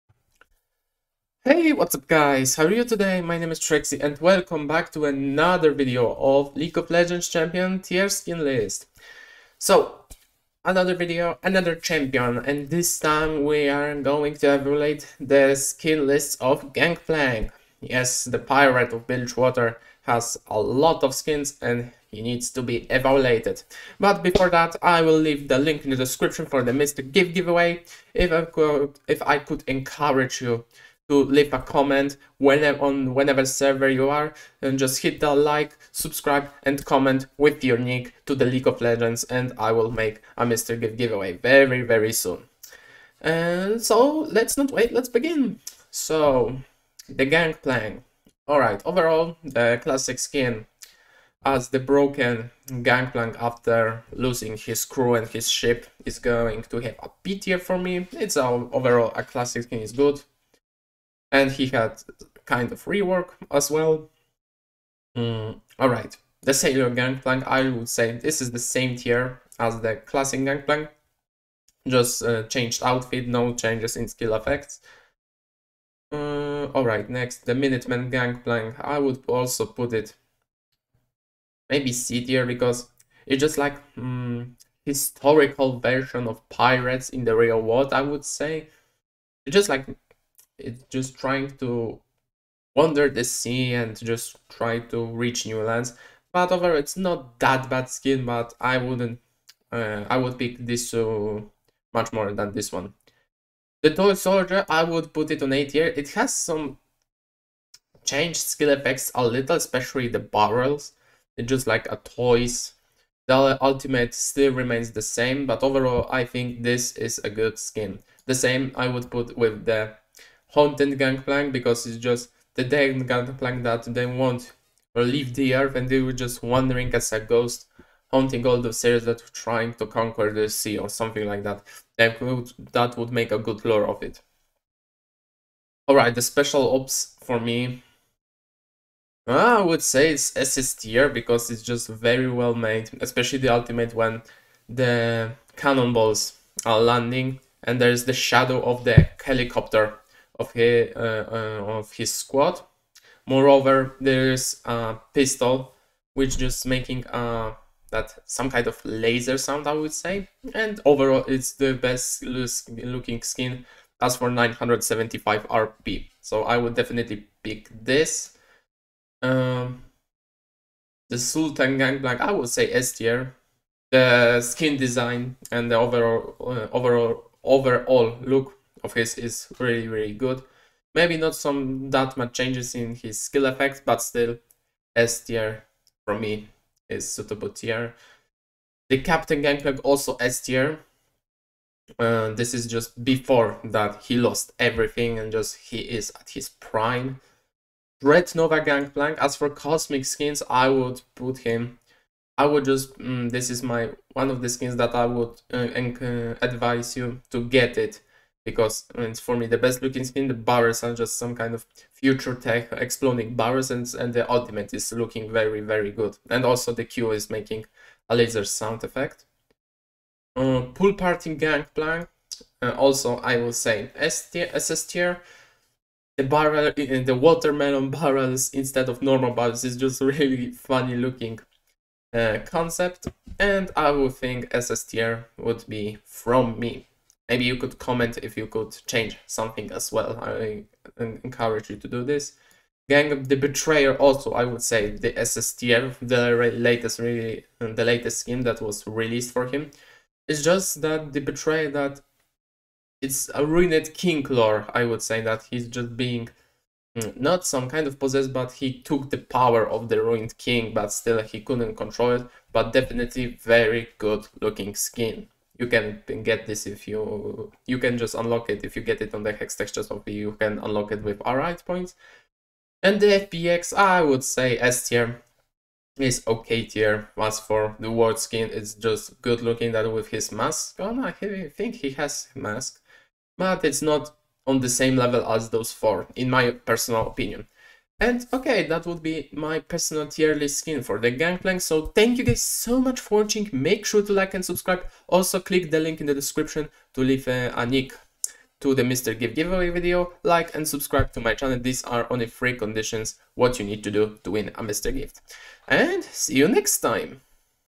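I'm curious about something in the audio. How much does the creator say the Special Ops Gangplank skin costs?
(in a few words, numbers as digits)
975 RP.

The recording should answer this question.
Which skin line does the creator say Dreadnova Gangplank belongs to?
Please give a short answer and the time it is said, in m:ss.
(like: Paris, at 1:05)
Cosmic, at 3:19.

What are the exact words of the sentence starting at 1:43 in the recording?
The Toy Soldier, I would put it on A tier.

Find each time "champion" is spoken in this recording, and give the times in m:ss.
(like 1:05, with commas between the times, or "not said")
0:07, 0:11.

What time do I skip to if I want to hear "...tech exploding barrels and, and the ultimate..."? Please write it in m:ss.
3:32.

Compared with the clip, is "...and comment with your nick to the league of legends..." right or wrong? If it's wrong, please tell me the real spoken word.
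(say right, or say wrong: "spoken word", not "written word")
right.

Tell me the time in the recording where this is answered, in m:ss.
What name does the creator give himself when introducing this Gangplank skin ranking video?
0:03.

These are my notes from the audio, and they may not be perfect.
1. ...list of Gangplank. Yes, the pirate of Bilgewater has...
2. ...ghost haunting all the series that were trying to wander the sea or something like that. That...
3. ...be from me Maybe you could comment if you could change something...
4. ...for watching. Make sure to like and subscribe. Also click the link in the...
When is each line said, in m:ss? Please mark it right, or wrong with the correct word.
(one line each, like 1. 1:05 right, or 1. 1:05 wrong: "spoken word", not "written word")
1. 0:16 right
2. 2:07 wrong: "conquer", not "wander"
3. 3:55 right
4. 4:52 right.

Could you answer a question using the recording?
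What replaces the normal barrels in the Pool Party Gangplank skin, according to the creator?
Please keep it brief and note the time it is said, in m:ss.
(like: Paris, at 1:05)
Watermelon barrels, at 3:47.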